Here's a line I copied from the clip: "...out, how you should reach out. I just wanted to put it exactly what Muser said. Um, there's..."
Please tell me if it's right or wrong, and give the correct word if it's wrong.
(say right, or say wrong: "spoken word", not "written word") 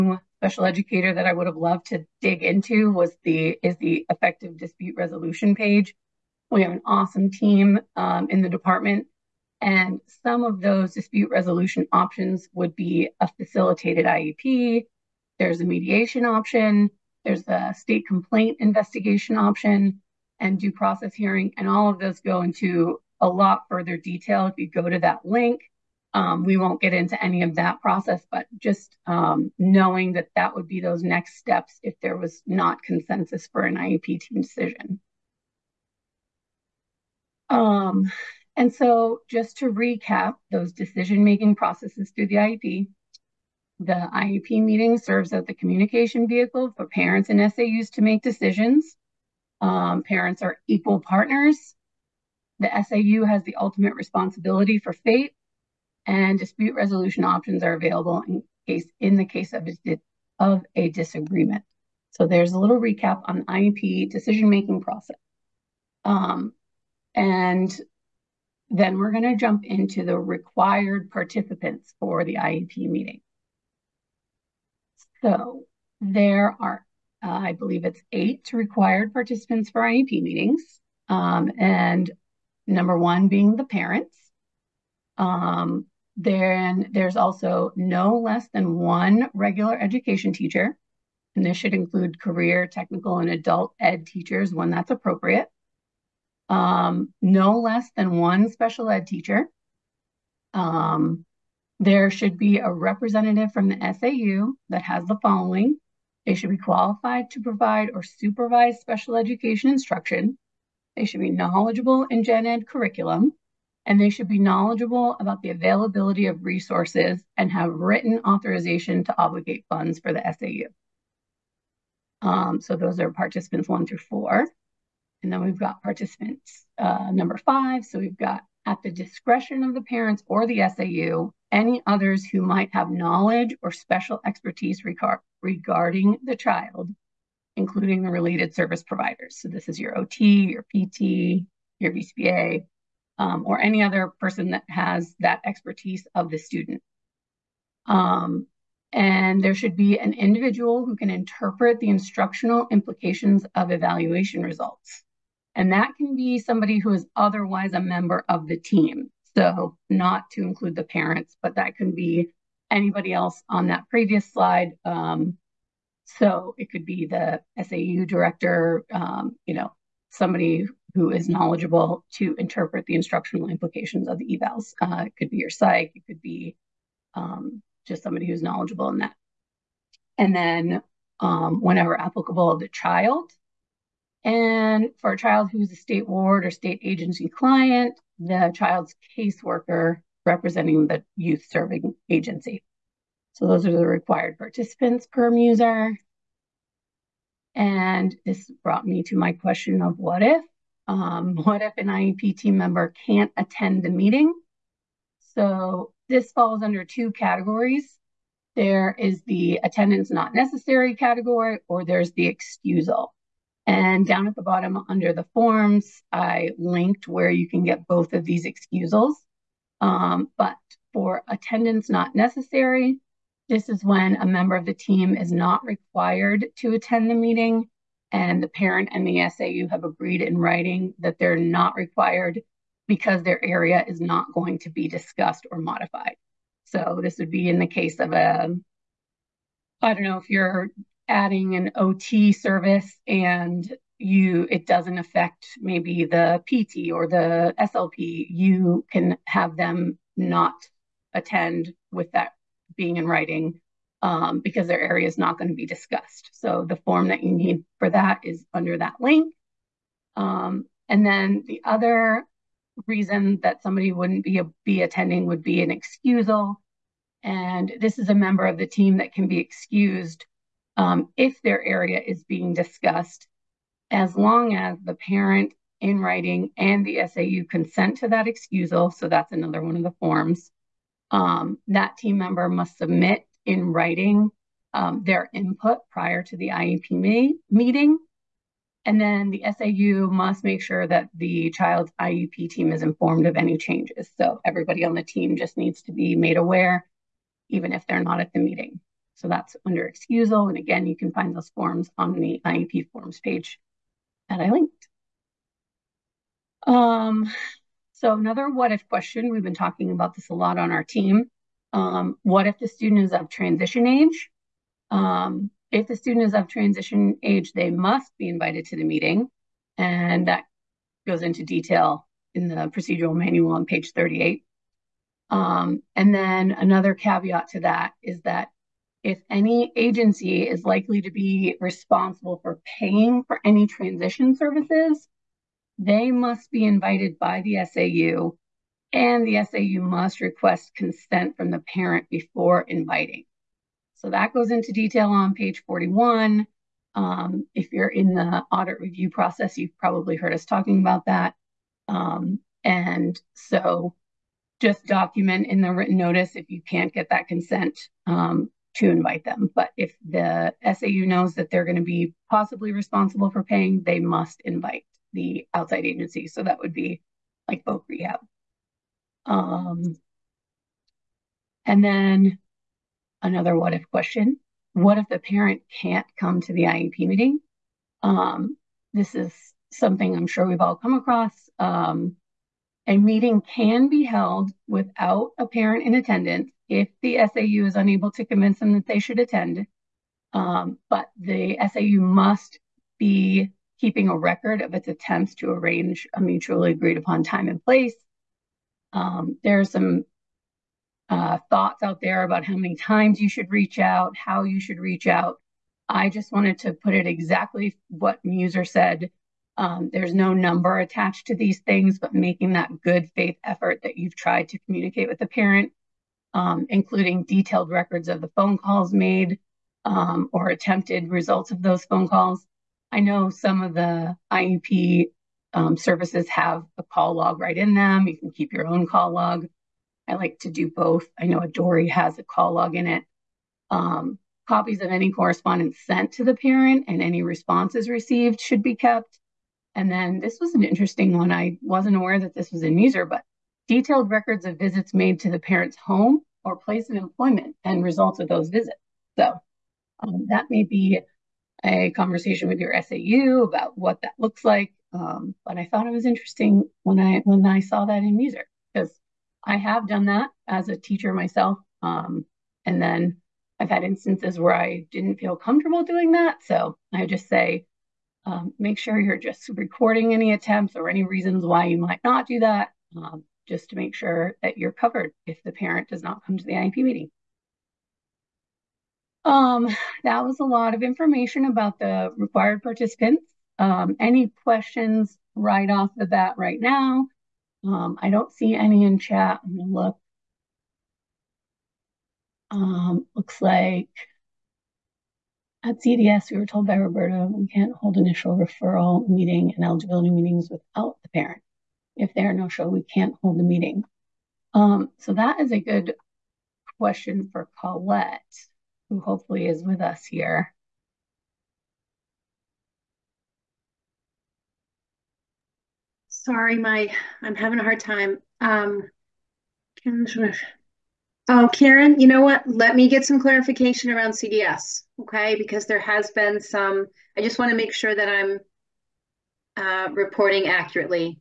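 right.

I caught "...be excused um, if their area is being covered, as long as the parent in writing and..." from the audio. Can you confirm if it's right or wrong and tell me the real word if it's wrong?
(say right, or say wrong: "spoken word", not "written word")
wrong: "discussed", not "covered".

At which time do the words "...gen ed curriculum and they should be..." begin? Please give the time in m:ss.
1:52.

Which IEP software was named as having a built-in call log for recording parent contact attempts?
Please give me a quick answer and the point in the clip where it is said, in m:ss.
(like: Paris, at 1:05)
Adori, at 7:11.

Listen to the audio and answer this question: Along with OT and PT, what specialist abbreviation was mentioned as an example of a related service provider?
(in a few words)
BCBA.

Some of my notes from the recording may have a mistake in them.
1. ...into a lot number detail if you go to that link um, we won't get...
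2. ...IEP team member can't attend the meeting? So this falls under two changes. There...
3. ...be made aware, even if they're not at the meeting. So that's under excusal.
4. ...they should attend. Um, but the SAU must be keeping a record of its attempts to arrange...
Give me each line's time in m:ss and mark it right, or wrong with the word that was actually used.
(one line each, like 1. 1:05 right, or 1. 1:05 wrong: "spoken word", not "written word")
1. 0:22 wrong: "further", not "number"
2. 3:21 wrong: "categories", not "changes"
3. 4:55 right
4. 6:28 right.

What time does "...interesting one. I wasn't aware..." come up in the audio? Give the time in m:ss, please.
7:20.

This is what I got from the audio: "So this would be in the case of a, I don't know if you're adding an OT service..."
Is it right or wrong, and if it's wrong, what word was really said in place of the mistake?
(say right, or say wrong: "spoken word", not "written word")
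right.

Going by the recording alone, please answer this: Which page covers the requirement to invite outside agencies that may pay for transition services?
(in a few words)
41.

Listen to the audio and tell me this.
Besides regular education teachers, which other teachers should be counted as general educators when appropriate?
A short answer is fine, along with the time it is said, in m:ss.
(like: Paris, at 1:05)
career, technical, and adult ed teachers, at 1:32.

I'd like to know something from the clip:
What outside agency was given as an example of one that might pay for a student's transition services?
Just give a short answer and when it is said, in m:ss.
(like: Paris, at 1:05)
Voc Rehab, at 6:07.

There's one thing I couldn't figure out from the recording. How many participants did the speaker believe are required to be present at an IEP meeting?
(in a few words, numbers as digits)
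8.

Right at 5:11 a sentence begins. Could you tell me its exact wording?
Um, what if the student is of transition age?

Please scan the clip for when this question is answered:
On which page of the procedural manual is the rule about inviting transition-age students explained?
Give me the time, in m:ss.
5:23.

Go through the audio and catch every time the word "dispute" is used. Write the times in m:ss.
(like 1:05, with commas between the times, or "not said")
0:04, 0:10, 0:56.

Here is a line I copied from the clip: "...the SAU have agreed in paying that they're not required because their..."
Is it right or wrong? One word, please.
wrong.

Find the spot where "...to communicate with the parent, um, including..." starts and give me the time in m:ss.
6:54.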